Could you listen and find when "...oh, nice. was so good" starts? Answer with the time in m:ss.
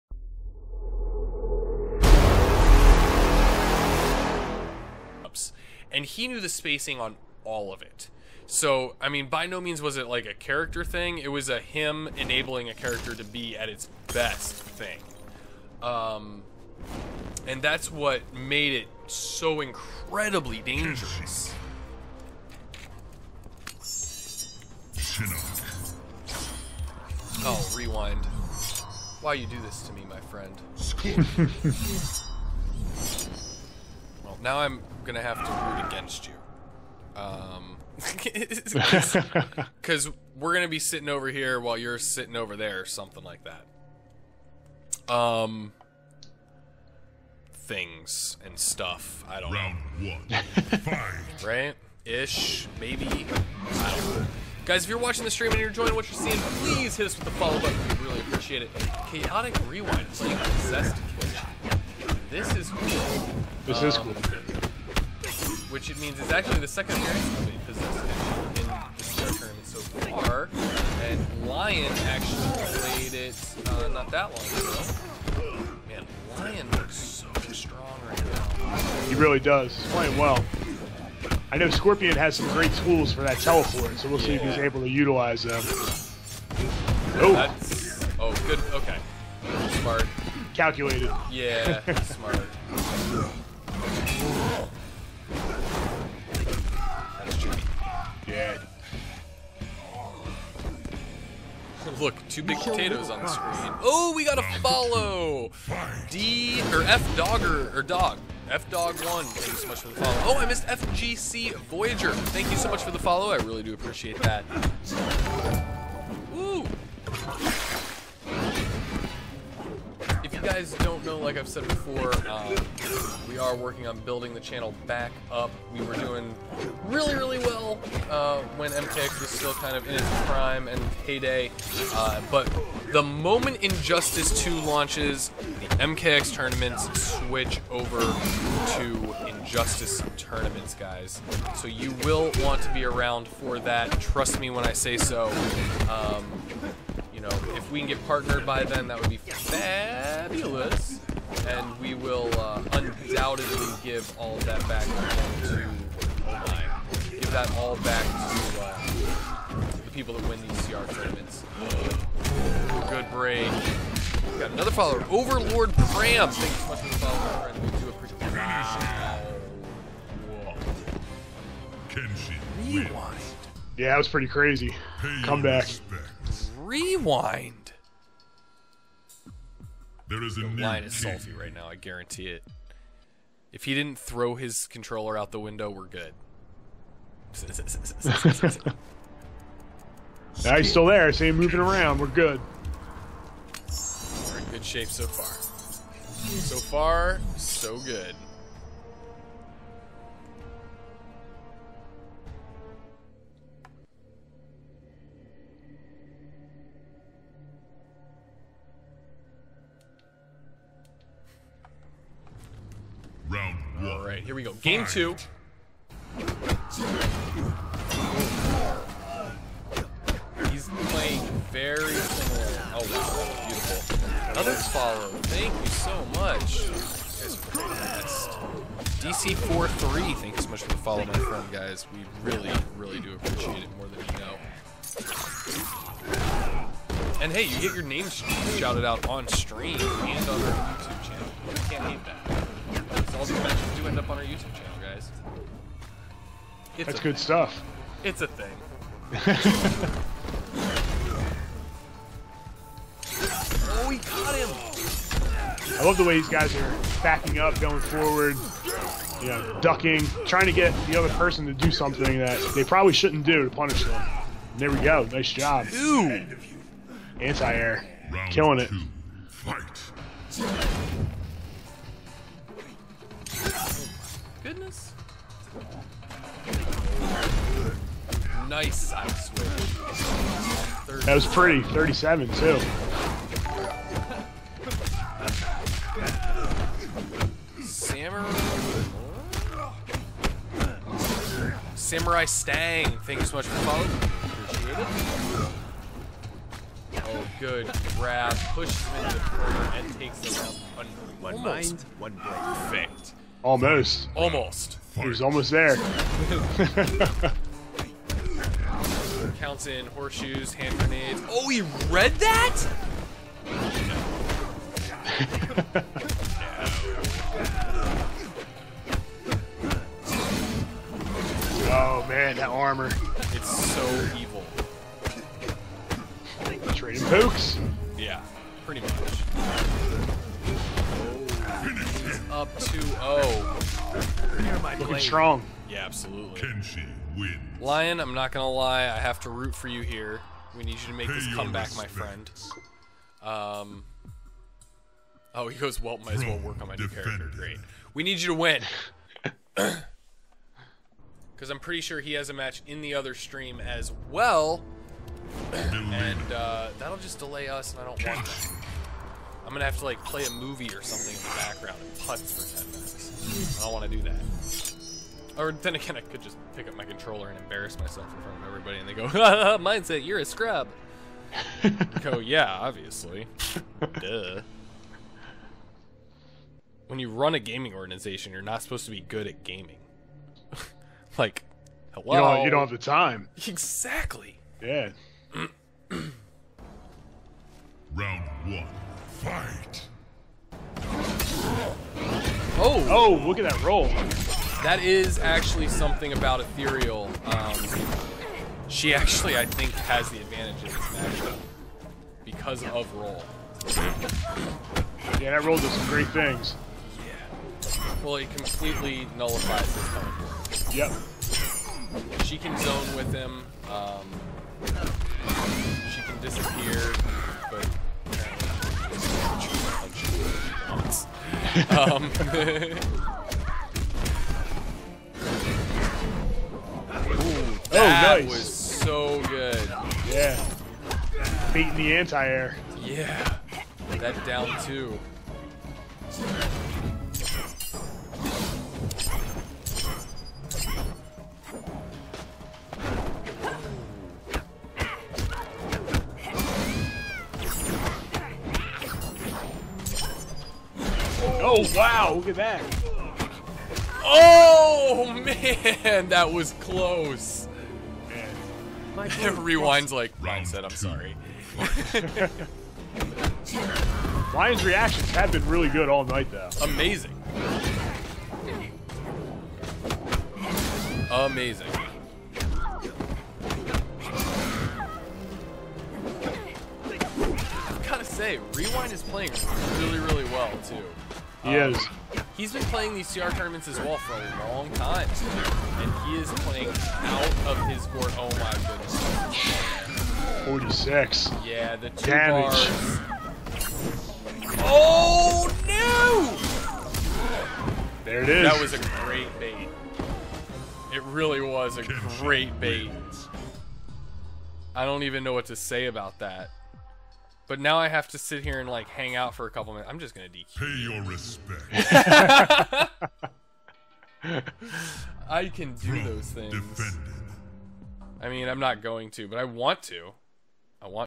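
7:07.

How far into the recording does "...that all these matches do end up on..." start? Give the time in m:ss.
4:02.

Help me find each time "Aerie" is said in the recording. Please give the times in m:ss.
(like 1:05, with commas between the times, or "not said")
not said.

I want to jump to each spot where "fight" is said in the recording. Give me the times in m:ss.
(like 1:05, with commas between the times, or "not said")
0:50, 4:29, 6:29.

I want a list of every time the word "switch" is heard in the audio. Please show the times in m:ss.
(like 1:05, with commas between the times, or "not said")
2:17, 4:38.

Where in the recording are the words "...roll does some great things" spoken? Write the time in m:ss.
6:45.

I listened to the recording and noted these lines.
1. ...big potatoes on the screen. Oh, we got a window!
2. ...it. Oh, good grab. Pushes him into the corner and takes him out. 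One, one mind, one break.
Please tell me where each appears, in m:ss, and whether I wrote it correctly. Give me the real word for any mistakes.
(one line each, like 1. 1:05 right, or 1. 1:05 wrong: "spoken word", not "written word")
1. 1:42 wrong: "follow", not "window"
2. 4:55 right.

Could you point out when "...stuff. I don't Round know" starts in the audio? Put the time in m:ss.
0:48.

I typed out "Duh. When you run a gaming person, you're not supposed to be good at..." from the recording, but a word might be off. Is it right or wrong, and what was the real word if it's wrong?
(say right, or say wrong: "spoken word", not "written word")
wrong: "organization", not "person".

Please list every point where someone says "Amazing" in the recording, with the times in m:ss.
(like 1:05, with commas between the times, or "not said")
7:46, 7:51.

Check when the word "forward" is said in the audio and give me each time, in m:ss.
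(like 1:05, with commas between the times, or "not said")
4:17.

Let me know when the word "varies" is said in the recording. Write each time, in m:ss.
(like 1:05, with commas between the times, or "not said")
not said.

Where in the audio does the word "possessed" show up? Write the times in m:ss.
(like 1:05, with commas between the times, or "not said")
1:00, 1:07.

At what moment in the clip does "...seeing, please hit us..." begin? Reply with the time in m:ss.
0:56.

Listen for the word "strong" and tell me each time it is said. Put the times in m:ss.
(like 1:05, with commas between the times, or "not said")
1:17, 5:34.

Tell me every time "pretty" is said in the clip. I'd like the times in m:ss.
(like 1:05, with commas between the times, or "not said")
2:54, 4:41, 5:28, 5:51.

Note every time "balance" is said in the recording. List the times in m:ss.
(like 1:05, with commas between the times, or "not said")
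not said.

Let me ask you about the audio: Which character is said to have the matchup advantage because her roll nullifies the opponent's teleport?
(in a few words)
Ethereal.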